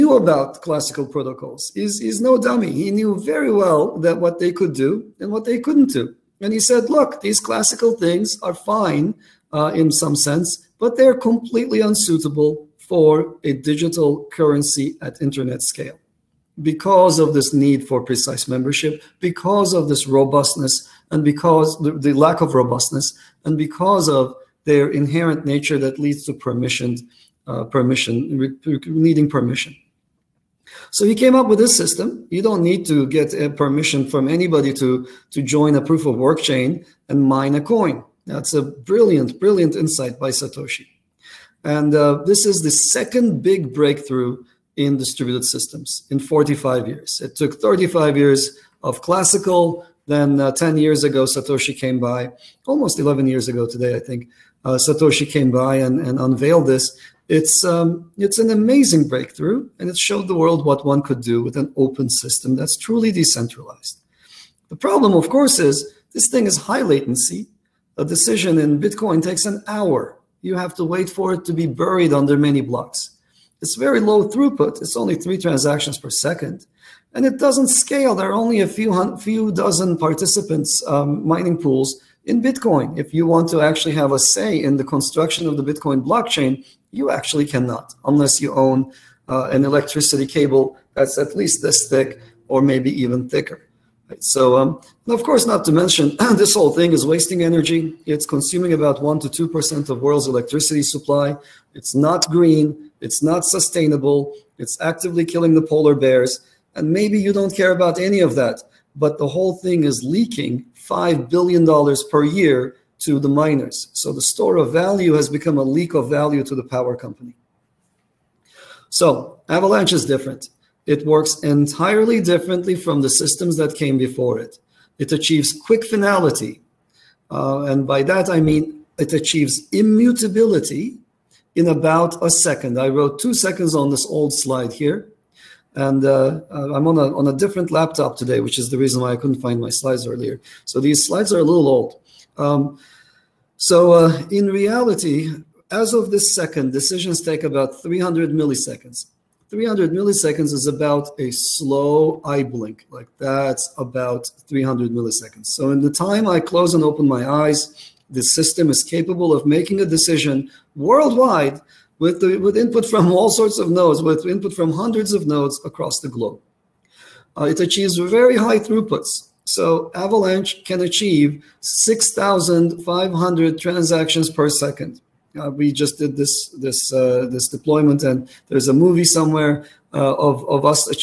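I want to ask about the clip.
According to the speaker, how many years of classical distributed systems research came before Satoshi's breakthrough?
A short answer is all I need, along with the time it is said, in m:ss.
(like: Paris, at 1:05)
35 years, at 0:47.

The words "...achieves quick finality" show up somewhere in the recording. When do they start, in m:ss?
2:05.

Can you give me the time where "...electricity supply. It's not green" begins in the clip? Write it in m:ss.
1:40.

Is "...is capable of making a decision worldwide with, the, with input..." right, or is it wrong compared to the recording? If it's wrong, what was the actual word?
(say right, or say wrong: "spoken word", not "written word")
right.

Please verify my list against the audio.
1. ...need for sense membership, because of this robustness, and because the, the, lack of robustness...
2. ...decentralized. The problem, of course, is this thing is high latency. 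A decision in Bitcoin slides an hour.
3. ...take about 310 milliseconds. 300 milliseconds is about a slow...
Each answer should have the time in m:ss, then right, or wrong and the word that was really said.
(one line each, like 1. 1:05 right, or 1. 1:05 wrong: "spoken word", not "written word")
1. 0:17 wrong: "precise", not "sense"
2. 1:03 wrong: "takes", not "slides"
3. 2:27 wrong: "300", not "310".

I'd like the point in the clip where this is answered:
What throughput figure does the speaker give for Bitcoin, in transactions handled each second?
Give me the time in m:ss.
1:15.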